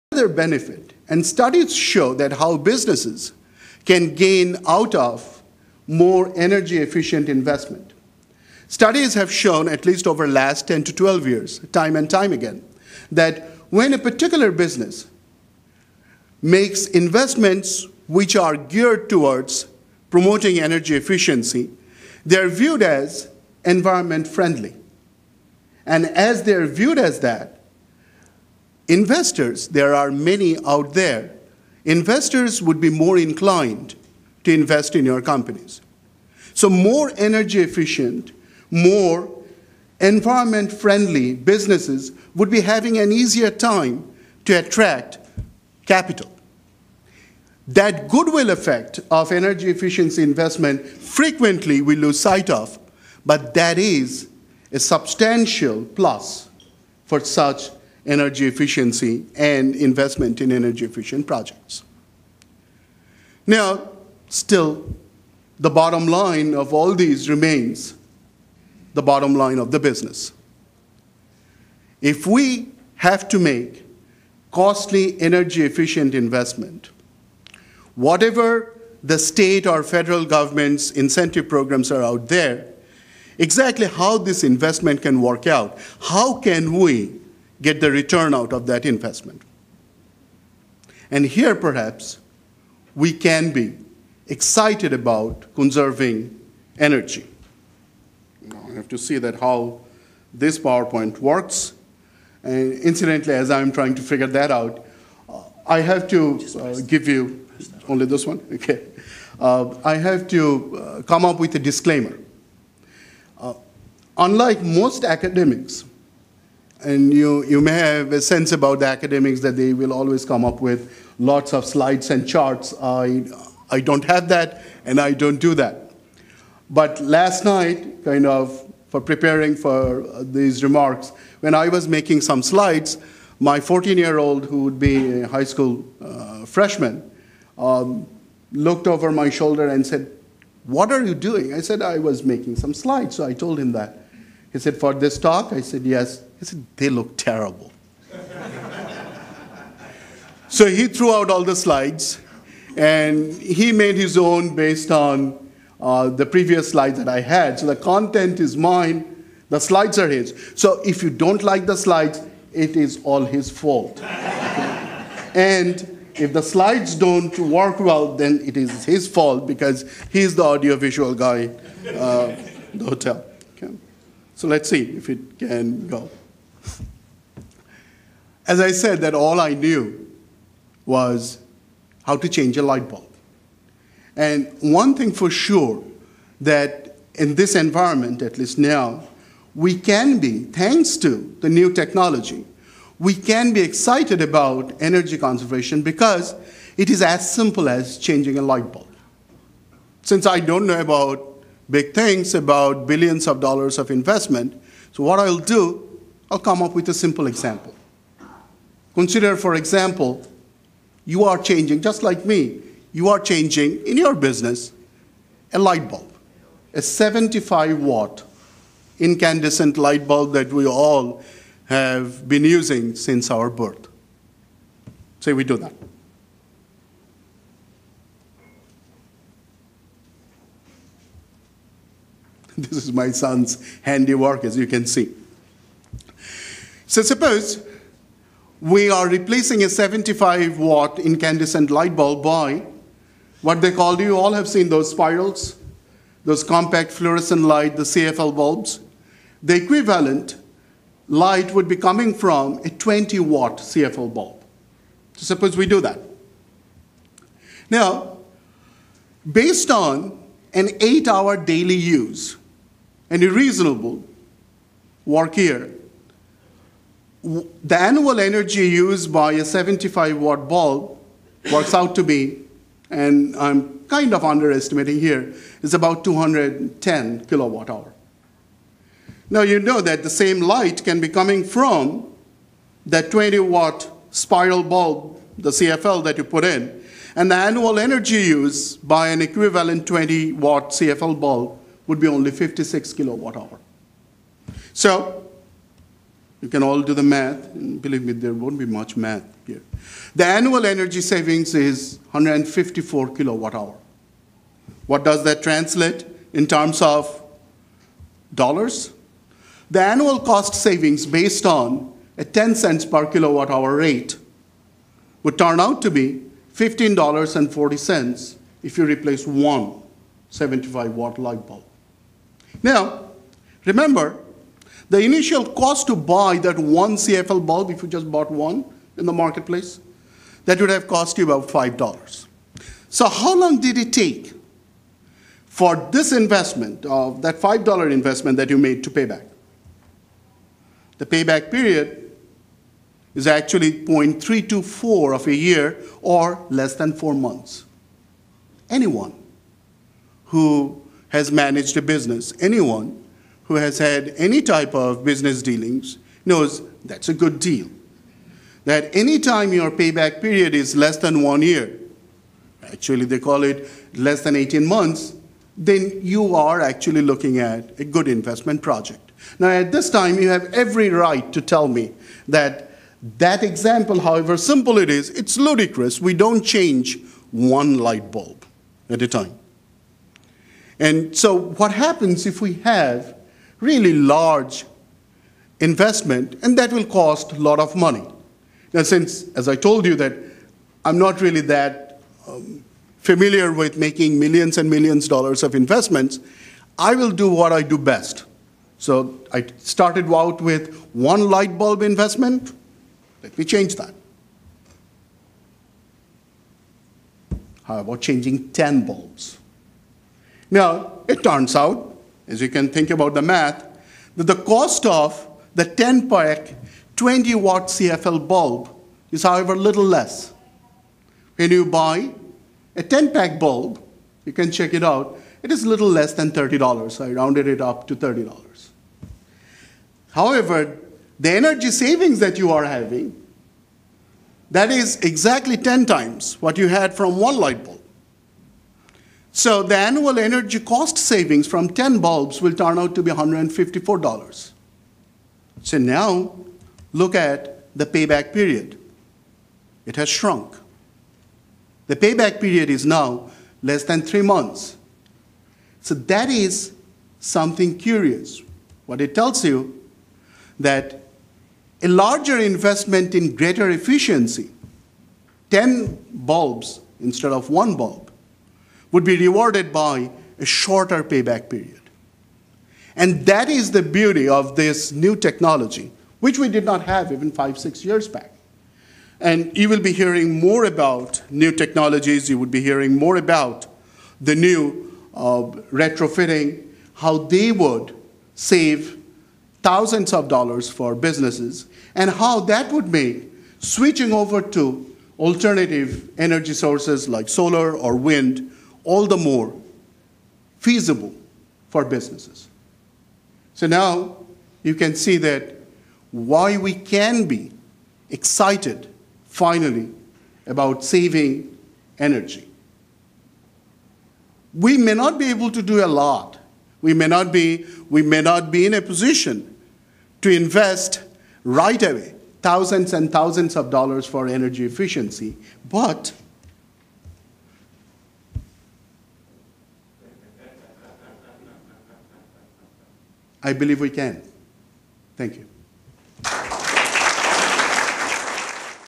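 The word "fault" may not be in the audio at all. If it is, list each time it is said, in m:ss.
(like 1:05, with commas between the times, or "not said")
2:43, 2:49.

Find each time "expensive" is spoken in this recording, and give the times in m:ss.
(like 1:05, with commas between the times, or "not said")
not said.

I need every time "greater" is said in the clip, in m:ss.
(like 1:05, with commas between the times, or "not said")
7:43.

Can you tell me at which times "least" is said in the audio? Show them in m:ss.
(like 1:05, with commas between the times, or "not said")
0:09, 3:08.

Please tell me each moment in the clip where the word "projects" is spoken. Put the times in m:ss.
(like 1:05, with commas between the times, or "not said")
1:01, 6:08.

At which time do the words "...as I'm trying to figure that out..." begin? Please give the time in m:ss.
1:43.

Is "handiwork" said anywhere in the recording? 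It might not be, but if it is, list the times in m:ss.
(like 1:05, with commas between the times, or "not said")
3:53.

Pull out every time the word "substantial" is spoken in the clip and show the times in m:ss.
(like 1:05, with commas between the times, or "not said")
0:54.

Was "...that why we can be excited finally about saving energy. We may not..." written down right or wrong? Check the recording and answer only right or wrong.
right.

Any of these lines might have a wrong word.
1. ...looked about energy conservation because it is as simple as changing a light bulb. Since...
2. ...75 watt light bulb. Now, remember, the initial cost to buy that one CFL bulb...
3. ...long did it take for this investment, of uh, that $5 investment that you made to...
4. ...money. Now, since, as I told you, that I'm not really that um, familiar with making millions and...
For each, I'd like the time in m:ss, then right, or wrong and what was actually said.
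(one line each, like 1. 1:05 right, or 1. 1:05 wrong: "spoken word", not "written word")
1. 3:13 wrong: "excited", not "looked"
2. 5:20 right
3. 5:33 right
4. 6:27 right.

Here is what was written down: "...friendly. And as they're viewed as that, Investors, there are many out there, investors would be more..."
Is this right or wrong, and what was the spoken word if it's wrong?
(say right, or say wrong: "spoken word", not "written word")
right.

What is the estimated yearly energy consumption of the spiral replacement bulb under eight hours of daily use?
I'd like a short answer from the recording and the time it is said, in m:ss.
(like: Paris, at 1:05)
56 kilowatt hours, at 4:52.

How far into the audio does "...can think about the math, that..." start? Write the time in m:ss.
6:52.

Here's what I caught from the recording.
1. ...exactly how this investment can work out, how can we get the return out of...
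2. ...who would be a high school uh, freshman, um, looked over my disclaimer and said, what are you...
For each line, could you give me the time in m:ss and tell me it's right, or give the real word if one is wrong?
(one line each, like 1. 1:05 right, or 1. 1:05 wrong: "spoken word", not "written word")
1. 1:23 right
2. 2:14 wrong: "shoulder", not "disclaimer".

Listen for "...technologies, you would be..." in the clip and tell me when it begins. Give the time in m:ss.
8:01.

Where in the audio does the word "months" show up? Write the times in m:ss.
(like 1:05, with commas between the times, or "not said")
5:47, 6:04, 7:34.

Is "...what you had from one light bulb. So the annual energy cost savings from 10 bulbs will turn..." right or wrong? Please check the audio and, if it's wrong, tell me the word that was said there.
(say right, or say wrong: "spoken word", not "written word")
right.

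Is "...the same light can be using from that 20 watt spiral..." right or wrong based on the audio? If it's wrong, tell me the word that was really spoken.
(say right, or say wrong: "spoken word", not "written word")
wrong: "coming", not "using".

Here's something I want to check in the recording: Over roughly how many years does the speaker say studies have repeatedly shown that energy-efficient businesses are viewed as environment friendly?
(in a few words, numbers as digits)
10 to 12 years.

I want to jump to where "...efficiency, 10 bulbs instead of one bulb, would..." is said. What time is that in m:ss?
7:43.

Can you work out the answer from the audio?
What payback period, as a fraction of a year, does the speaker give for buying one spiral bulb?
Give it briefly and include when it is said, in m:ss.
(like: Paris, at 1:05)
0.324, at 5:43.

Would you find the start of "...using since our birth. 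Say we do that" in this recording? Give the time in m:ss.
3:42.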